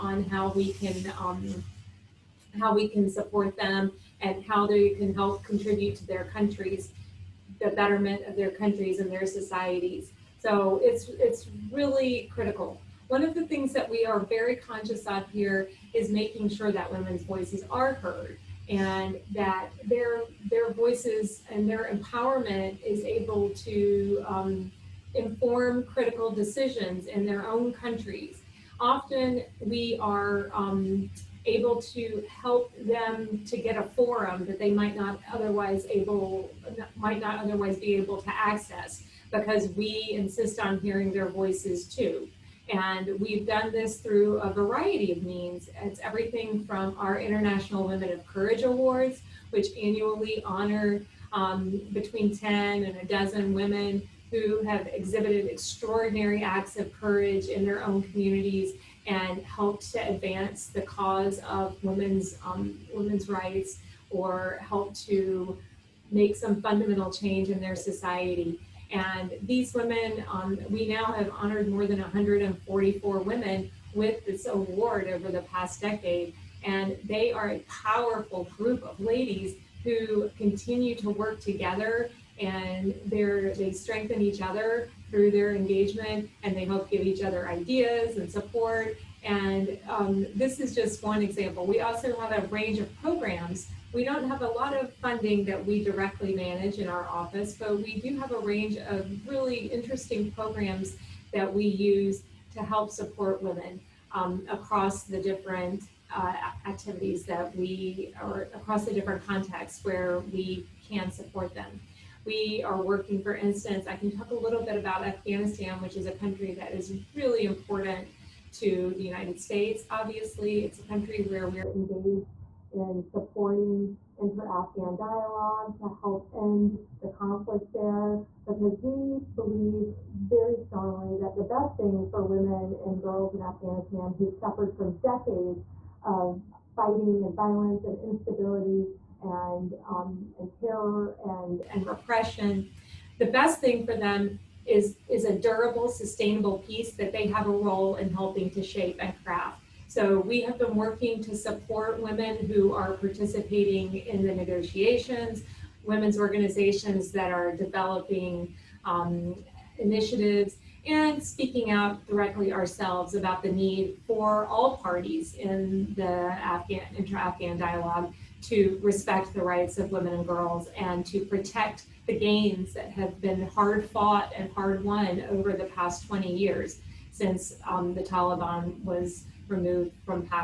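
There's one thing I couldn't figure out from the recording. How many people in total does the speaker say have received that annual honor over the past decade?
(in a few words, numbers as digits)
more than 144.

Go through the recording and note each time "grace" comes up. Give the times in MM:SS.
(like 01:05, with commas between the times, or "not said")
not said.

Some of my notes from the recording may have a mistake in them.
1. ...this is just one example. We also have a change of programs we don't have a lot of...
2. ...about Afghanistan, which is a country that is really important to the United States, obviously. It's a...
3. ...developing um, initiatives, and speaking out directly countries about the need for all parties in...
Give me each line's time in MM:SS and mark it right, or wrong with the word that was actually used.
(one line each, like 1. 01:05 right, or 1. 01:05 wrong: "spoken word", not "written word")
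1. 01:30 wrong: "range", not "change"
2. 01:54 right
3. 02:37 wrong: "ourselves", not "countries".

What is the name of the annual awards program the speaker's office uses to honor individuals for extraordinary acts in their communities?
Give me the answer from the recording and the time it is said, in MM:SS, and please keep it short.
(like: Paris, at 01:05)
International Women of Courage Awards, at 00:47.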